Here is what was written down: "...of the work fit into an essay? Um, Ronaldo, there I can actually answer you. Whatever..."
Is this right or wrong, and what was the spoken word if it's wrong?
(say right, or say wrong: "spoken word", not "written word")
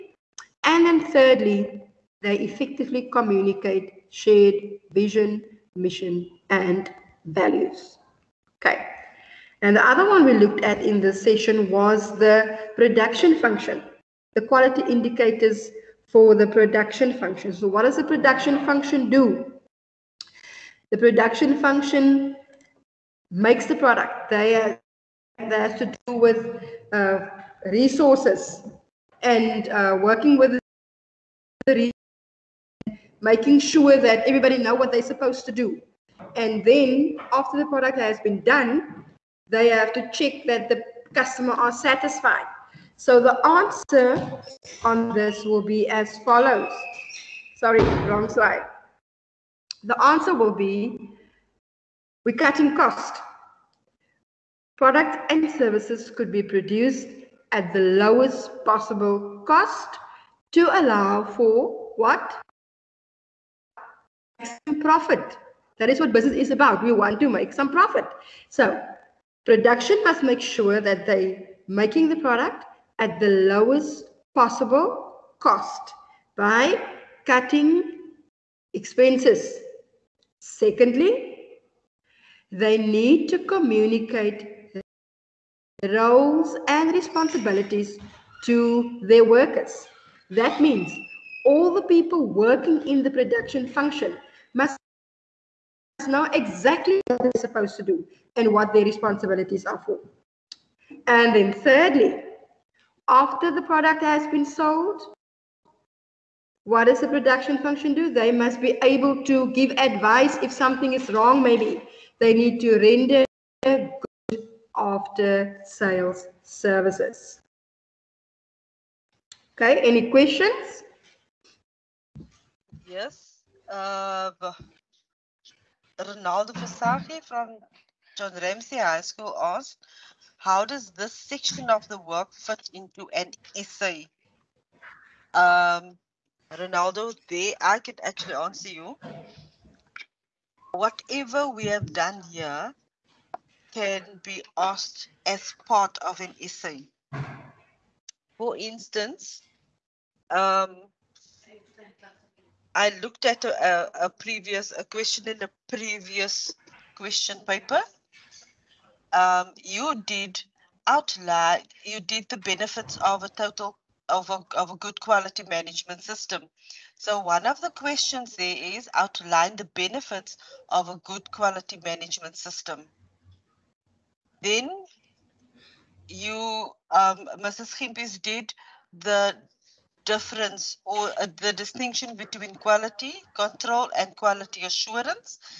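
right.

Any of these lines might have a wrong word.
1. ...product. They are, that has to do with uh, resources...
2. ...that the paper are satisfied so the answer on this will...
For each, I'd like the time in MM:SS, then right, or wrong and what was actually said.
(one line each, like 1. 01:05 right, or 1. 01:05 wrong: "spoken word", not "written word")
1. 00:23 right
2. 00:40 wrong: "customer", not "paper".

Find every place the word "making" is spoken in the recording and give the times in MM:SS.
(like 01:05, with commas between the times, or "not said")
00:33, 01:11.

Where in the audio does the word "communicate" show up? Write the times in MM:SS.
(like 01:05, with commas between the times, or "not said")
00:03, 01:23.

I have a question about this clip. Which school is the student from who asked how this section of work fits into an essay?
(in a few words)
John Ramsey High School.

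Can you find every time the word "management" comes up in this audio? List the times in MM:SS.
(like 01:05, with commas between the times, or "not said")
02:45, 02:51.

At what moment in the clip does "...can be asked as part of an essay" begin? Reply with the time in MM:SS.
02:23.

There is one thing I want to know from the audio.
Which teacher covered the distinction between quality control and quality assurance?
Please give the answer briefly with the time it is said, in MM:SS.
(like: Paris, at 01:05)
Mrs. Himpis, at 02:57.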